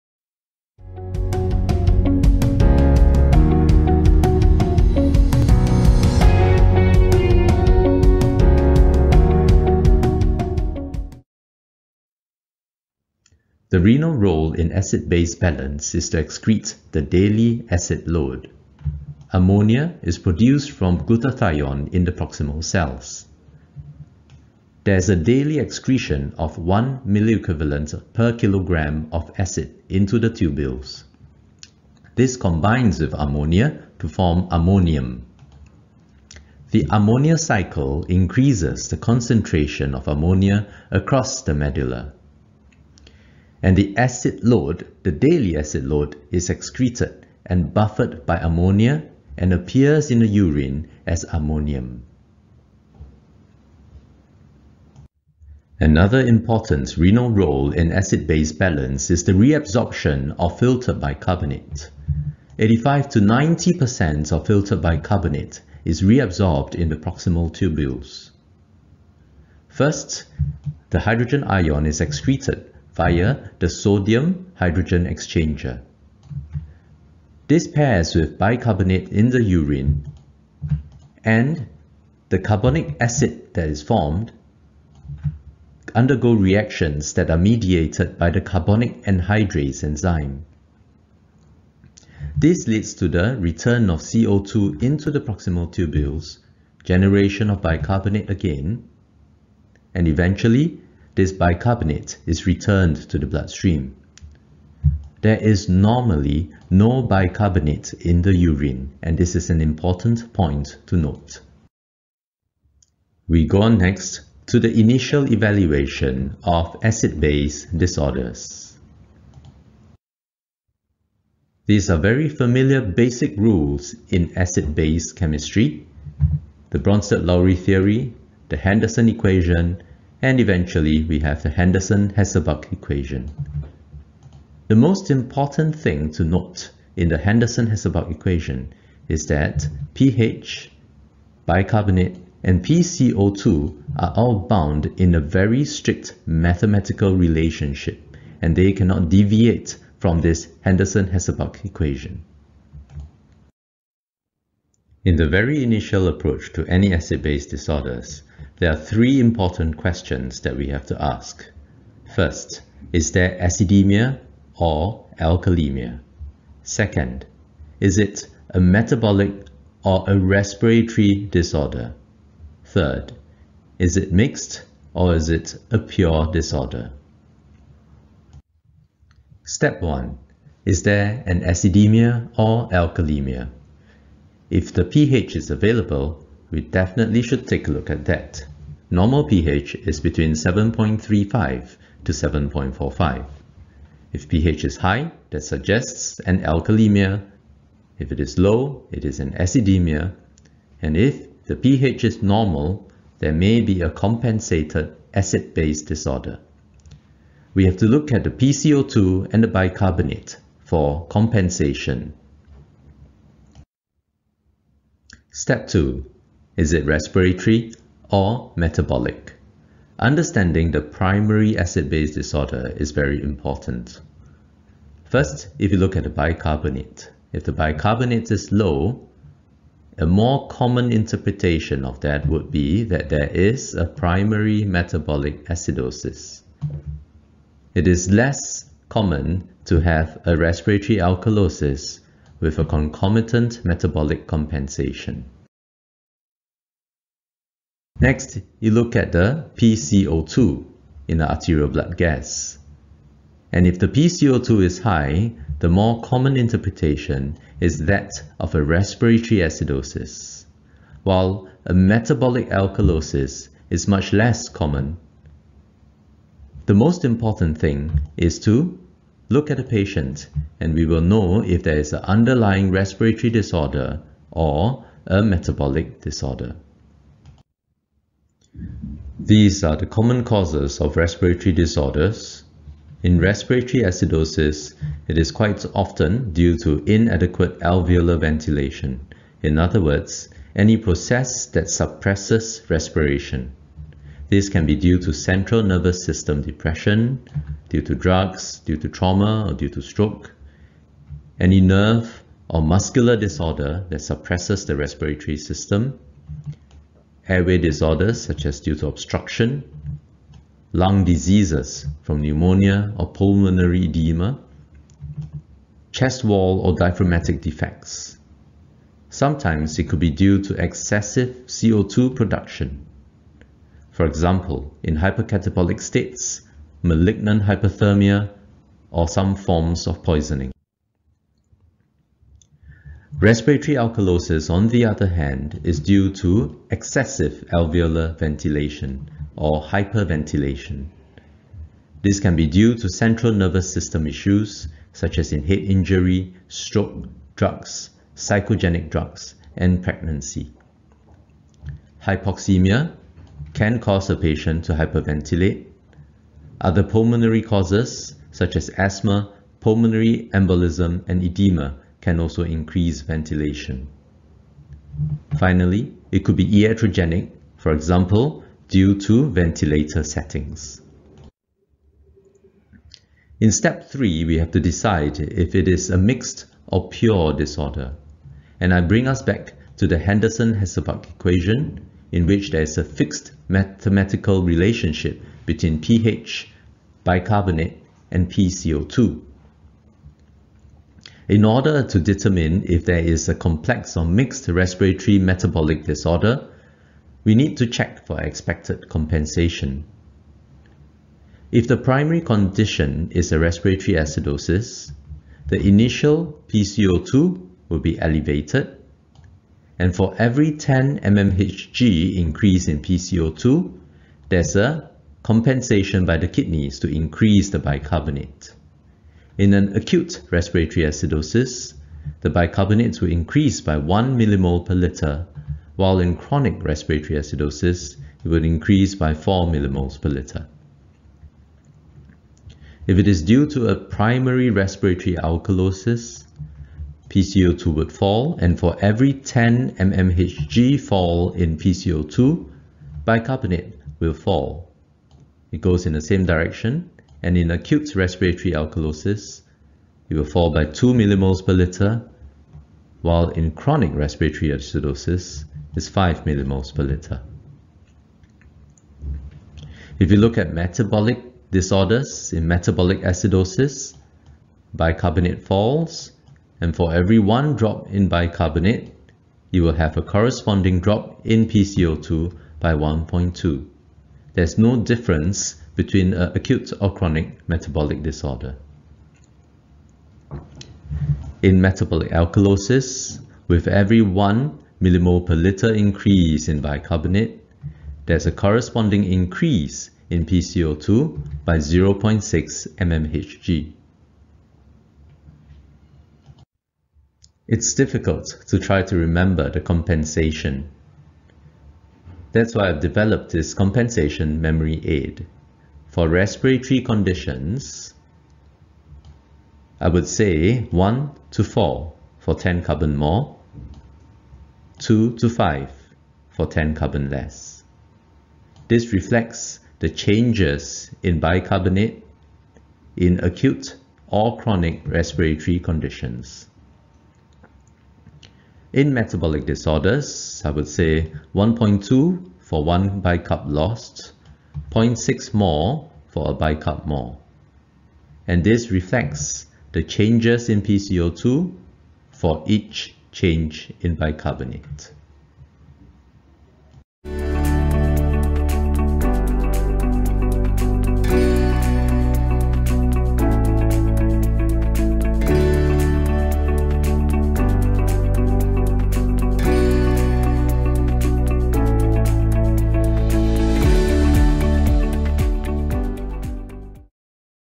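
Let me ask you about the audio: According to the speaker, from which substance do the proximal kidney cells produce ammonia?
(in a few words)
Glutathione.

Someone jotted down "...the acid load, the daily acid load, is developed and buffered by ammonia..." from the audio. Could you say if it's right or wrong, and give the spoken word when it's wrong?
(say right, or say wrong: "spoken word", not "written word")
wrong: "excreted", not "developed".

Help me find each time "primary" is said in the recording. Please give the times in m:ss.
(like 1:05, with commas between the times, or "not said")
3:40, 3:53, 6:41, 7:13.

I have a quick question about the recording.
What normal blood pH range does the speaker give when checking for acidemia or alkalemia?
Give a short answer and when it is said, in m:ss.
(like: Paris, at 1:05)
7.35 to 7.45, at 3:10.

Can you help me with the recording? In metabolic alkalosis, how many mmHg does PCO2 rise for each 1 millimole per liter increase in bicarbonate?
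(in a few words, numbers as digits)
0.6 mmHg.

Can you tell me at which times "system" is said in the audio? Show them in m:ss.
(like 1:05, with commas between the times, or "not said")
4:56, 5:05, 5:43.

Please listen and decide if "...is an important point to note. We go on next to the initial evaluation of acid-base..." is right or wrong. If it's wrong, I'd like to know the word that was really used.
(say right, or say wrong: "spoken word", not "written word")
right.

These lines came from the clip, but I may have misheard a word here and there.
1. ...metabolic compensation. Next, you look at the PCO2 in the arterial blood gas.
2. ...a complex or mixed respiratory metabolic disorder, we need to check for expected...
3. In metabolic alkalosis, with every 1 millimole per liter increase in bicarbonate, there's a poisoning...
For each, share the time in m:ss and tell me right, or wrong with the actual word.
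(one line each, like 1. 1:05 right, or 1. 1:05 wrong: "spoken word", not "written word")
1. 4:03 right
2. 6:33 right
3. 8:01 wrong: "corresponding", not "poisoning".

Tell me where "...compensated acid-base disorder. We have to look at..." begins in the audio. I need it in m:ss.
3:23.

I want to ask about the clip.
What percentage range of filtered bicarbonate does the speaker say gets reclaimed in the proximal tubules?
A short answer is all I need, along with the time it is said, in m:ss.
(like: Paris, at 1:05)
85 to 90%, at 1:02.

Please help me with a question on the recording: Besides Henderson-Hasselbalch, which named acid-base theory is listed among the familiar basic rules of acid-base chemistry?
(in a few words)
Bronsted-Lowry theory.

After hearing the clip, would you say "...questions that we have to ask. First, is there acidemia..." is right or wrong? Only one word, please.
right.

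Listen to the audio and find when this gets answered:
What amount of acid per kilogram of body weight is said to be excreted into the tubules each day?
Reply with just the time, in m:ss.
0:26.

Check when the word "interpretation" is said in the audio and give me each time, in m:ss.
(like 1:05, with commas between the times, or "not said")
3:50, 4:16.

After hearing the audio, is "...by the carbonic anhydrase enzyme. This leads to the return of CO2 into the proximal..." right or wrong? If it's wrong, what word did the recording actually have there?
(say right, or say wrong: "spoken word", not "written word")
right.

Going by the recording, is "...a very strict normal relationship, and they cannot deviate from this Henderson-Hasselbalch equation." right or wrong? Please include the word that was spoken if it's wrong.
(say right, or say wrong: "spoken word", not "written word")
wrong: "mathematical", not "normal".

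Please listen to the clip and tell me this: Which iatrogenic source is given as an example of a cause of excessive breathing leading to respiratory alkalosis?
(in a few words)
Ventilator settings.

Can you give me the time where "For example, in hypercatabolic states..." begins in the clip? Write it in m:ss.
5:23.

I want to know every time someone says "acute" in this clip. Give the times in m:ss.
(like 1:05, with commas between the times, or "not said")
6:59, 7:27, 7:56, 8:43.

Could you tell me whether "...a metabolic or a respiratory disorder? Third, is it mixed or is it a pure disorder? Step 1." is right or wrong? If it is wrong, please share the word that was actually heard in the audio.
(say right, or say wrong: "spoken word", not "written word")
right.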